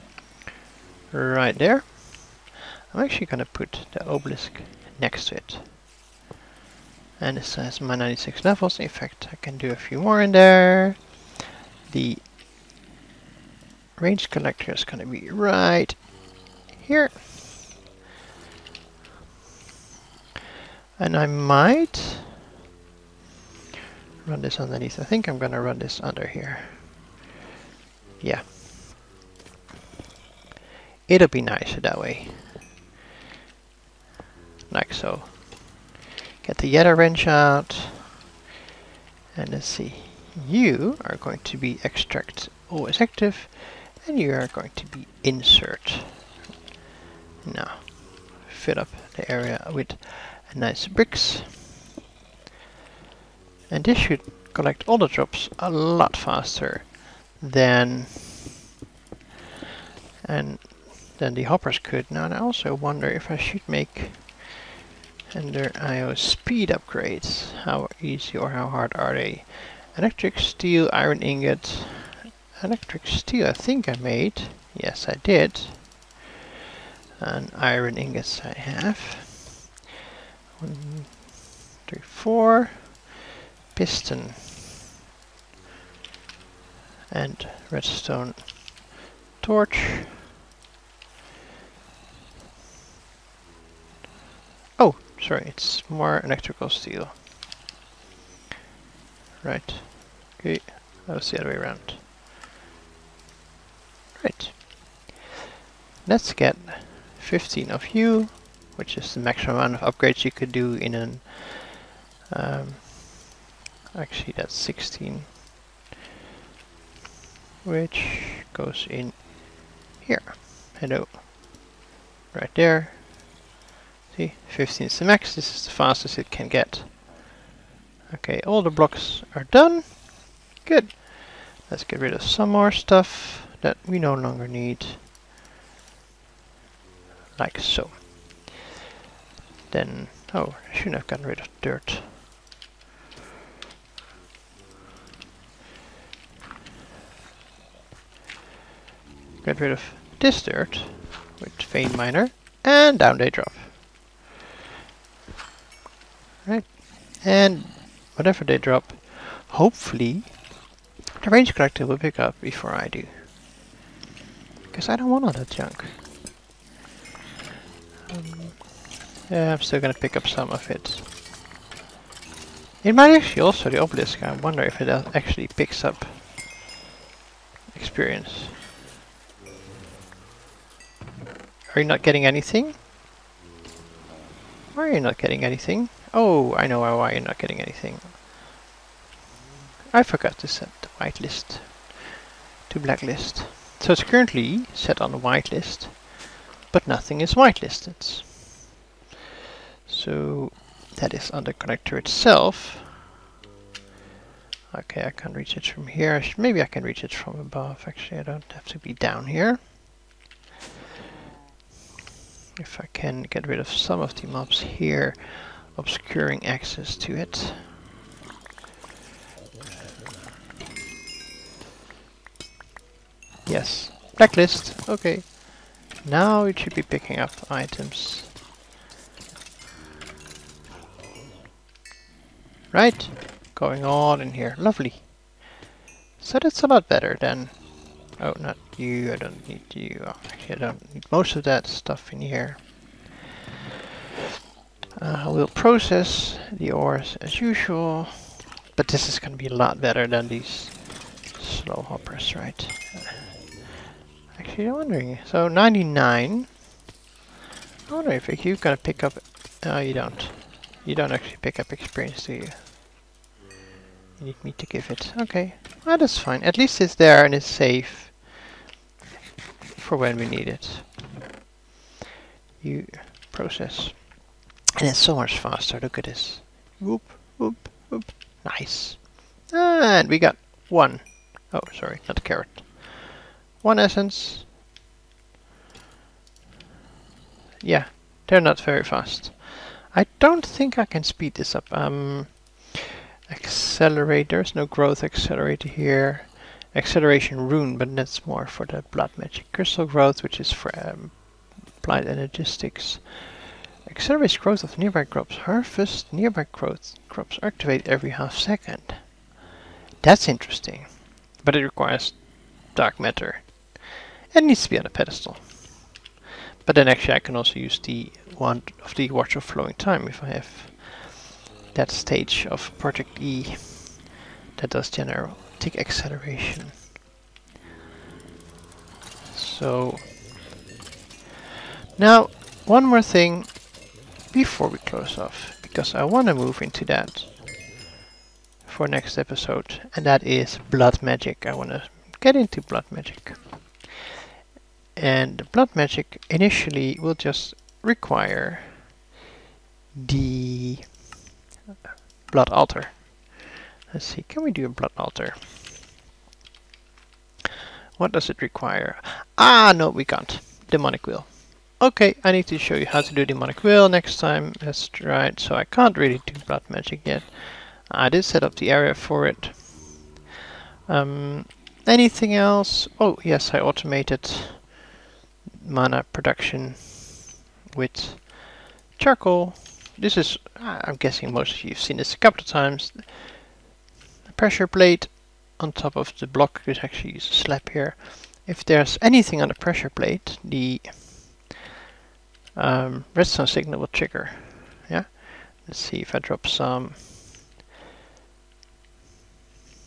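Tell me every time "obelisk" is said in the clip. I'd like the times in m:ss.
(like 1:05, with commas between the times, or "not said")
0:04, 2:53.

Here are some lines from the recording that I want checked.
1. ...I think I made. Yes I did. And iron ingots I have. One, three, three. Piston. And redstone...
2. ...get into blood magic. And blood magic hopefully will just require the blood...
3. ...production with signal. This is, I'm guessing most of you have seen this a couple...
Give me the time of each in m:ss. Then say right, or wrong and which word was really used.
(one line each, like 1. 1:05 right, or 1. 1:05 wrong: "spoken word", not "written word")
1. 1:13 wrong: "four", not "three"
2. 5:42 wrong: "initially", not "hopefully"
3. 6:16 wrong: "charcoal", not "signal".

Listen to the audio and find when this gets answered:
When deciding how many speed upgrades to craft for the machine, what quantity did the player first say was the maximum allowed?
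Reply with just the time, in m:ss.
1:47.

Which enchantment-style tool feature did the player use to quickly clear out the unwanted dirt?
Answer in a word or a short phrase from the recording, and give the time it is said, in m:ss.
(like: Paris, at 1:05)
Vein miner, at 2:31.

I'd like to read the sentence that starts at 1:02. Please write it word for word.
Now I also wonder if I should make Ender IO speed upgrades.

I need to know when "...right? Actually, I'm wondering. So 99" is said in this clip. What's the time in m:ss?
4:12.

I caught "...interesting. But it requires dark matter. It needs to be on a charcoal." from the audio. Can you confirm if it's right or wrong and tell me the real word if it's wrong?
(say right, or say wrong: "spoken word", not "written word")
wrong: "pedestal", not "charcoal".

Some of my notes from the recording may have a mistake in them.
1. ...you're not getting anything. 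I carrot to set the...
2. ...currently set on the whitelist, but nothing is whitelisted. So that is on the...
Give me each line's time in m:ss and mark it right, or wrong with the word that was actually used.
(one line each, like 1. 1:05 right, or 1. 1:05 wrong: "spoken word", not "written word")
1. 3:07 wrong: "forgot", not "carrot"
2. 3:14 right.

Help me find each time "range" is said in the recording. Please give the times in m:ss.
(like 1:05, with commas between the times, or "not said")
0:13, 2:41.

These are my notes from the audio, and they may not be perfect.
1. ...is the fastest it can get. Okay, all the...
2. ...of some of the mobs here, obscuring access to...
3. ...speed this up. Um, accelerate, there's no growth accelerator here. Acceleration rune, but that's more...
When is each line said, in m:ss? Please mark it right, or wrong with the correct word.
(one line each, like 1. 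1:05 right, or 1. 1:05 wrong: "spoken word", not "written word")
1. 2:05 right
2. 3:33 right
3. 4:51 right.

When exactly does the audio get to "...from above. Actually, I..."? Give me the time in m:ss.
3:27.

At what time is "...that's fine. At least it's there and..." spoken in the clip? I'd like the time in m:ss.
4:25.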